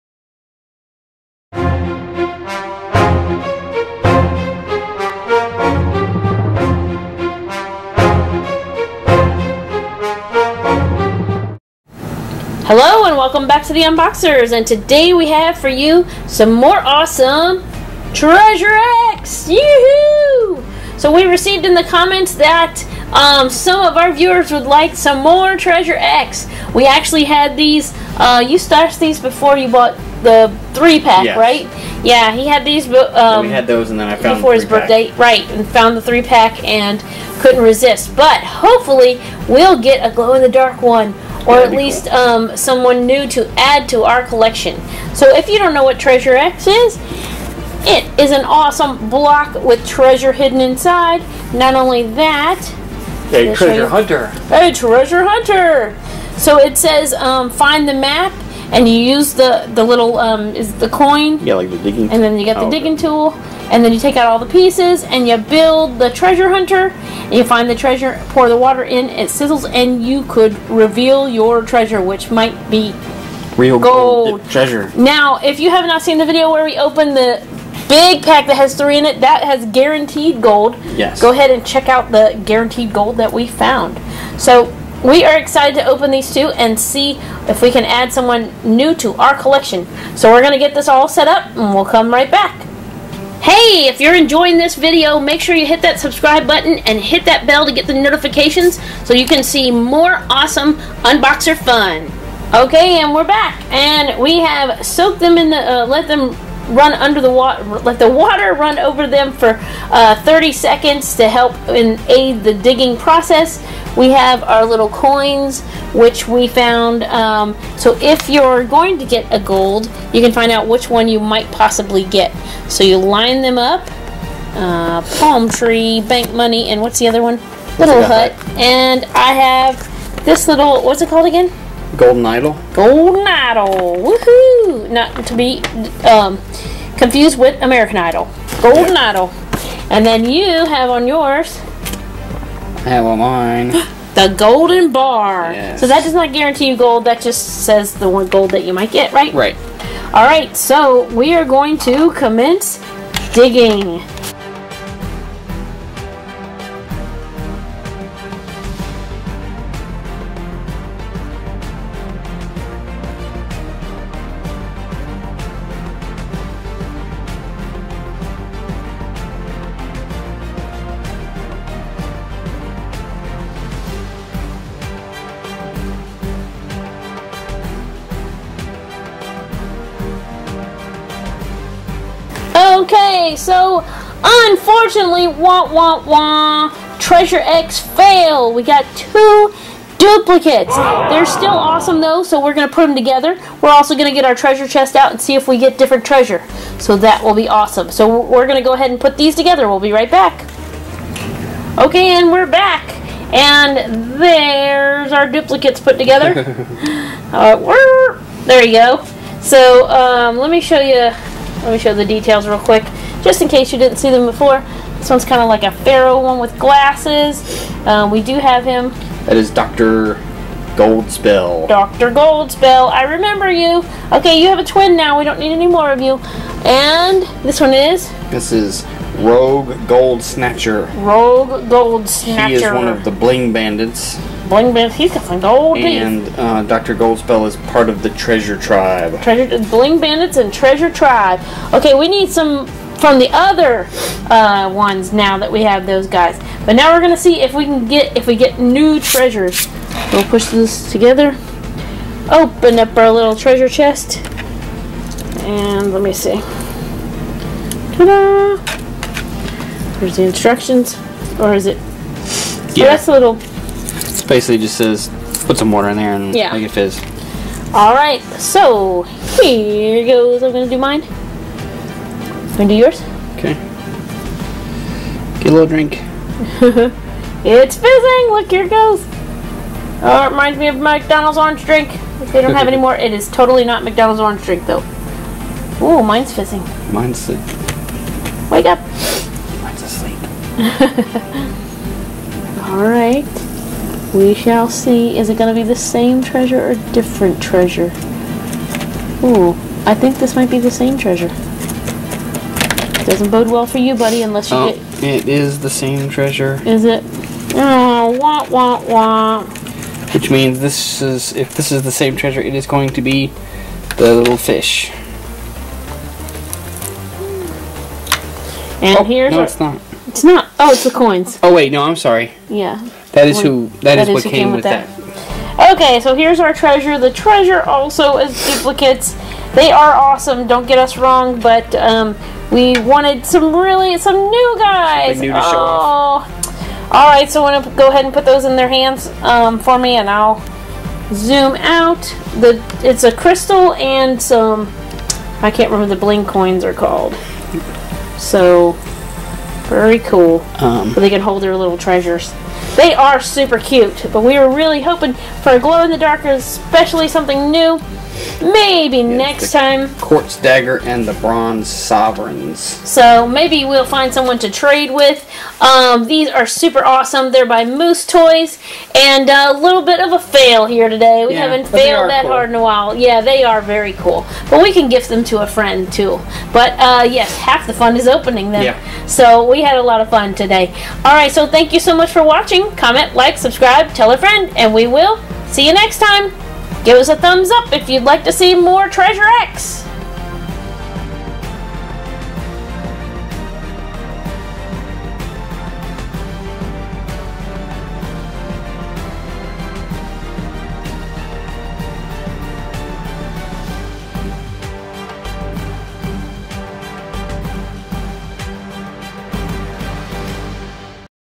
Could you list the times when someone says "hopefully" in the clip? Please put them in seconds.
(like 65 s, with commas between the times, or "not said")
38 s.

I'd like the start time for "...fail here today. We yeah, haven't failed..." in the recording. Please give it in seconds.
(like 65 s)
370 s.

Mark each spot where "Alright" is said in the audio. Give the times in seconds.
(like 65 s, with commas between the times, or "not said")
380 s.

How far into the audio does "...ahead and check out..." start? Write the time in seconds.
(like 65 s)
81 s.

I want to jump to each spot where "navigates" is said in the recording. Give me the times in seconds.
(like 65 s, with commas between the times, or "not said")
not said.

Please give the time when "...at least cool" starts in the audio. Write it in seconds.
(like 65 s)
41 s.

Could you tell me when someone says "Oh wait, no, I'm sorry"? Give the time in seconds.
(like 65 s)
321 s.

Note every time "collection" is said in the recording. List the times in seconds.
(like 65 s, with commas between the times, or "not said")
44 s, 89 s.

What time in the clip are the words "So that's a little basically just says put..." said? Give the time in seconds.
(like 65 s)
262 s.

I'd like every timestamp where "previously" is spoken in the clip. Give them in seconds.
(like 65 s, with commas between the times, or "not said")
not said.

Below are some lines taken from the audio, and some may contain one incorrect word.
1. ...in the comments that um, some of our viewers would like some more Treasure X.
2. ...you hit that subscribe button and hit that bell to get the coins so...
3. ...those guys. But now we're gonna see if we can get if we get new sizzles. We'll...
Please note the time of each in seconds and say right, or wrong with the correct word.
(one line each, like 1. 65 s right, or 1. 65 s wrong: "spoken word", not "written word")
1. 21 s right
2. 95 s wrong: "notifications", not "coins"
3. 245 s wrong: "treasures", not "sizzles".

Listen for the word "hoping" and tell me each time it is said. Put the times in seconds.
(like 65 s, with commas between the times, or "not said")
354 s.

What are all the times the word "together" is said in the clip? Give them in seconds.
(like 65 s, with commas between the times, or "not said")
192 s, 199 s, 205 s, 250 s.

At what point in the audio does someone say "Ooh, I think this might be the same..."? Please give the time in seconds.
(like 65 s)
299 s.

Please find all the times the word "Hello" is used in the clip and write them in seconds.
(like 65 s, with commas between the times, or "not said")
12 s.